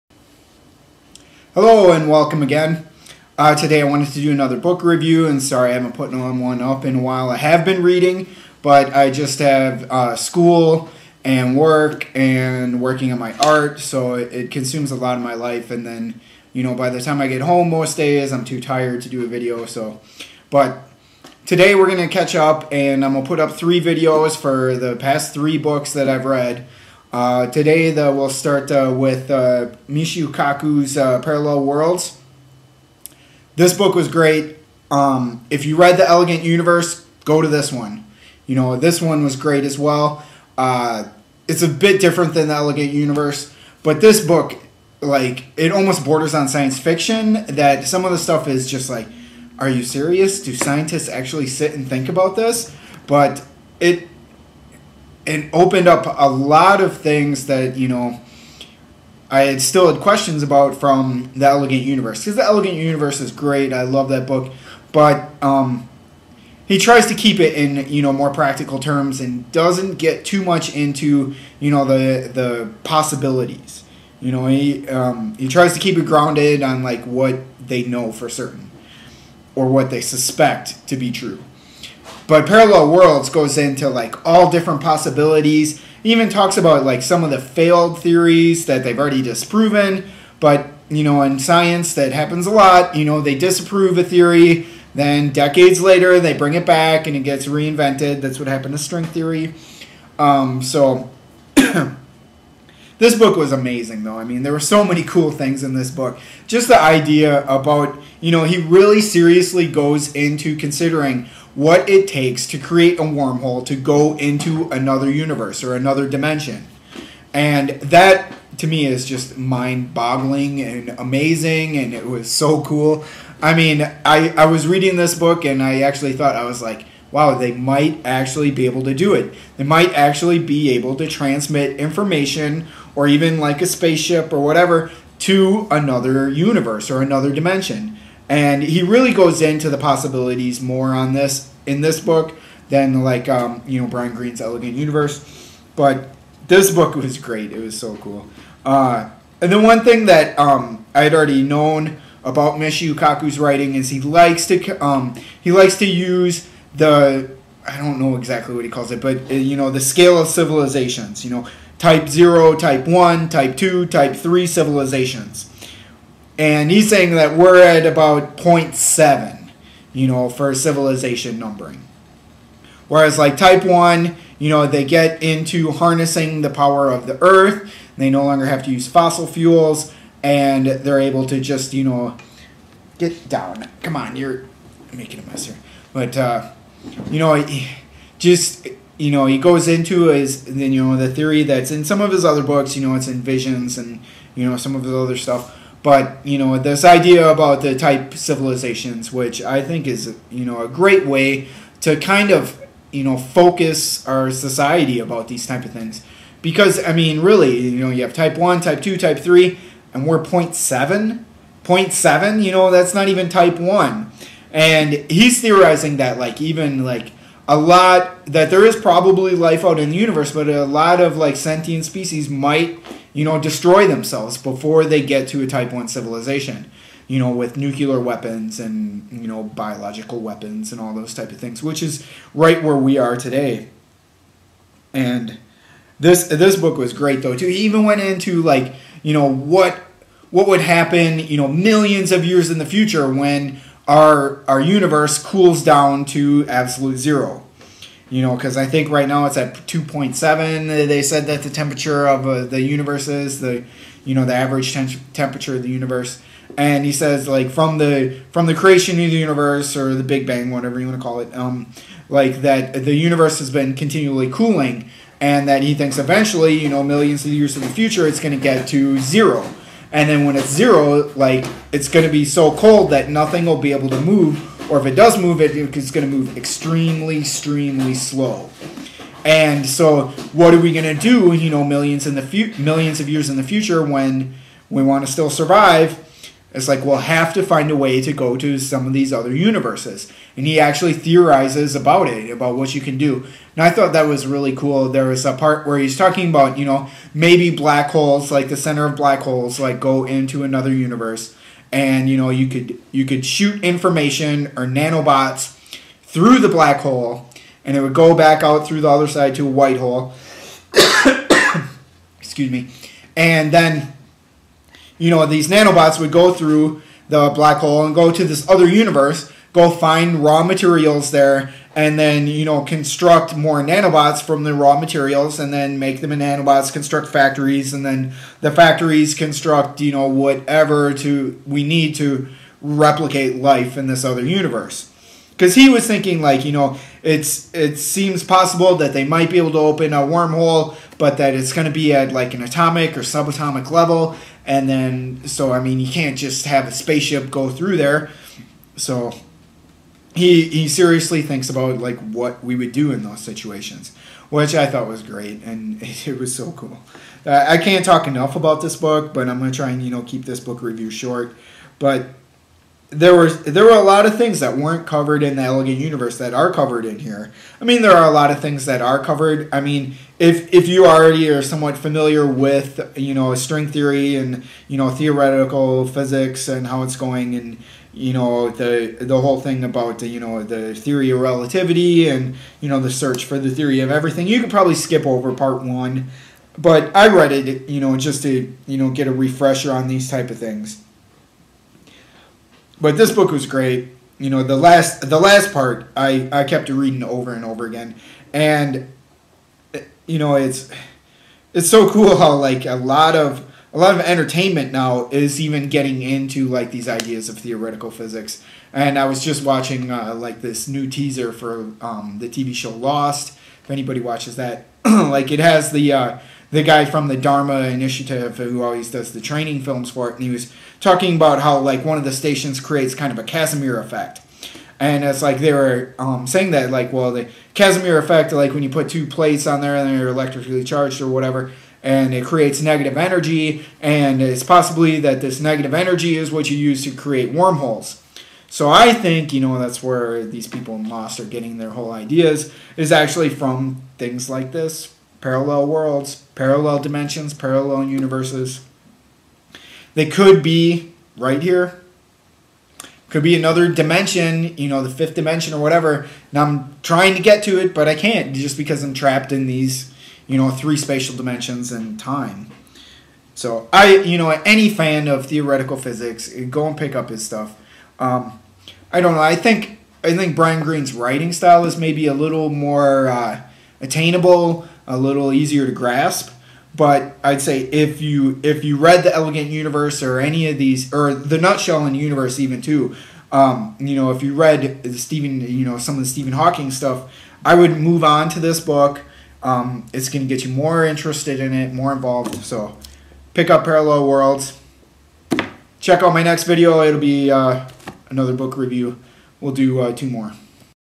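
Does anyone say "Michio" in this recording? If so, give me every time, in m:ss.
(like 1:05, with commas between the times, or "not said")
0:29, 2:32.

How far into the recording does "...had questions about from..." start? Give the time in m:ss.
0:59.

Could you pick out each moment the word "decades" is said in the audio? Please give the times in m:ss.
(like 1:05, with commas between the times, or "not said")
1:35.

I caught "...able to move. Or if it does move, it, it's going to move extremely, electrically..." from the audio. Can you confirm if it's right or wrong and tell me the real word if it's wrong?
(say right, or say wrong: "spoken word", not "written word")
wrong: "extremely", not "electrically".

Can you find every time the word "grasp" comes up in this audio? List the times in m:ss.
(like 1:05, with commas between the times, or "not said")
7:55.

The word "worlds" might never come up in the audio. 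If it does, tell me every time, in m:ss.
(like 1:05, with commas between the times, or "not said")
0:31, 1:22, 7:25, 8:14.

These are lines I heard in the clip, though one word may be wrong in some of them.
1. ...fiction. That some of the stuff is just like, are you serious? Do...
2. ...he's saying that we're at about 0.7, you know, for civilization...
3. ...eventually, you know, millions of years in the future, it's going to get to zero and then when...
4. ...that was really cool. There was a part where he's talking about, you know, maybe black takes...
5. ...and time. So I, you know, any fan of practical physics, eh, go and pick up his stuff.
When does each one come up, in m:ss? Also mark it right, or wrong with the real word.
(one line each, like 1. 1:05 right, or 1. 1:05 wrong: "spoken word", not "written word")
1. 0:46 right
2. 2:46 right
3. 4:25 right
4. 4:53 wrong: "holes", not "takes"
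5. 7:41 wrong: "theoretical", not "practical".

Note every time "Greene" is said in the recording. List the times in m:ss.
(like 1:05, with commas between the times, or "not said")
2:24, 7:50.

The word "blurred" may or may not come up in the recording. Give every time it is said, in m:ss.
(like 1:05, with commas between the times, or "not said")
not said.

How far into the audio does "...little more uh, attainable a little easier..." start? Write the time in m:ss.
7:52.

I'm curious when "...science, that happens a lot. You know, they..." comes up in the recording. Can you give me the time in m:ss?
1:31.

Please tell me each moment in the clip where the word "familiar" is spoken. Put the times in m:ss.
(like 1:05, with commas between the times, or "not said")
6:11.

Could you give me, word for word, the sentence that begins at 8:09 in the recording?
Um, it's going to get you more interested in it, more involved.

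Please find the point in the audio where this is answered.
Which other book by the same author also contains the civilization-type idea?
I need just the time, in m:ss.
3:13.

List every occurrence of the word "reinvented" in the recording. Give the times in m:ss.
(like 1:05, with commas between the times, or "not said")
1:37.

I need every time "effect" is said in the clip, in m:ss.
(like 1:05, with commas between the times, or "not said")
7:03, 7:07.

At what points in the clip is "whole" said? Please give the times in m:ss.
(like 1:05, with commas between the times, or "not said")
6:19, 7:21.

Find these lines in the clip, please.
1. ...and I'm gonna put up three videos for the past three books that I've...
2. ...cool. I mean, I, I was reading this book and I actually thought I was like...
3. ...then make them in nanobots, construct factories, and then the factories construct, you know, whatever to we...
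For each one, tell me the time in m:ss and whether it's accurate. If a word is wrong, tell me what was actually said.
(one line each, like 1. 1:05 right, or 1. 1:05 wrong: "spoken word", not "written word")
1. 0:22 right
2. 2:02 right
3. 5:25 right.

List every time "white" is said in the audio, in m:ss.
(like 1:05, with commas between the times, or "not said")
5:09.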